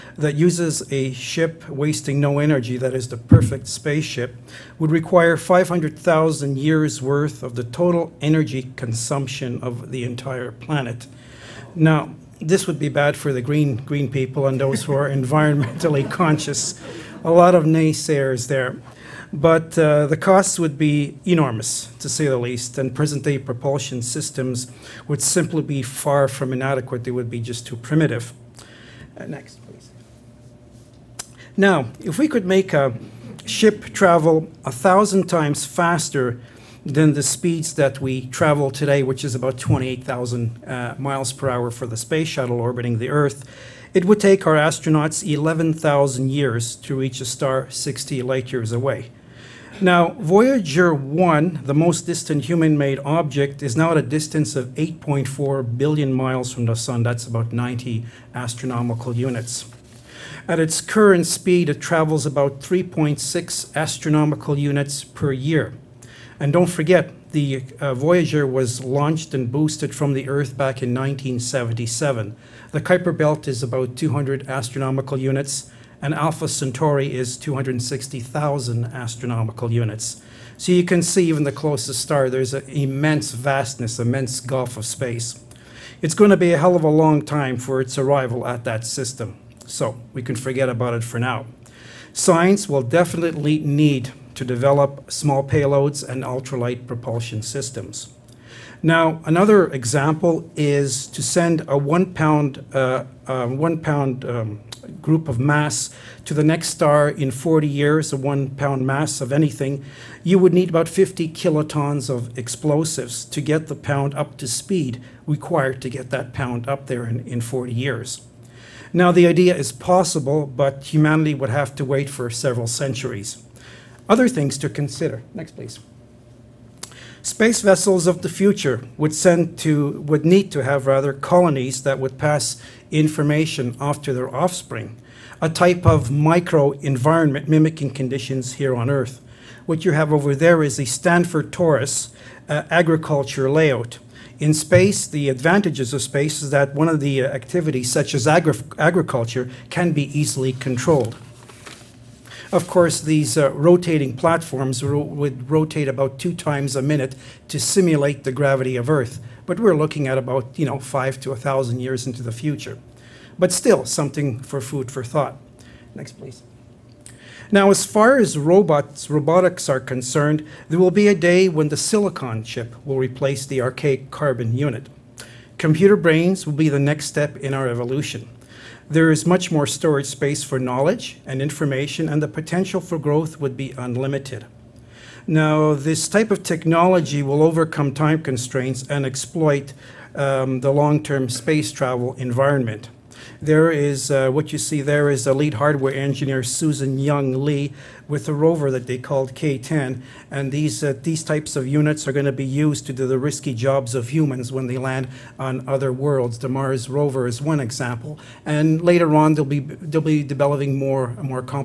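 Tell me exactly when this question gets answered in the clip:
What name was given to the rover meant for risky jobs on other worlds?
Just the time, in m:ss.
3:19.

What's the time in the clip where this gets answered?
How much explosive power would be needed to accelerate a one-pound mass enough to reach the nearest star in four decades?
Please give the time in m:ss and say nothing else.
1:50.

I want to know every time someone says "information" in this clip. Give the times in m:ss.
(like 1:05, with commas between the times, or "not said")
2:12, 3:01.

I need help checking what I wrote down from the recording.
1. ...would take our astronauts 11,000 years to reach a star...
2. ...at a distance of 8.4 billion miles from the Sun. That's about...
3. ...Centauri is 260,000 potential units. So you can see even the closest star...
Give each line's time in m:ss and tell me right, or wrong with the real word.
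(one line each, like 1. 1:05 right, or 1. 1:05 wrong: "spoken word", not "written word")
1. 0:44 right
2. 0:53 right
3. 1:16 wrong: "astronomical", not "potential".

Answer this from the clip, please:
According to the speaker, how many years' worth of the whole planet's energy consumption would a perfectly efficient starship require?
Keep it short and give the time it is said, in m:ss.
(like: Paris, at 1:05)
500,000, at 0:05.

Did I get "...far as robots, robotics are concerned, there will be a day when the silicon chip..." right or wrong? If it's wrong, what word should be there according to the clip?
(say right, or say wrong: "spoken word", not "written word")
right.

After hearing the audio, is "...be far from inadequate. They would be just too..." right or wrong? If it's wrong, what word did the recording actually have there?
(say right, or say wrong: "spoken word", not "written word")
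right.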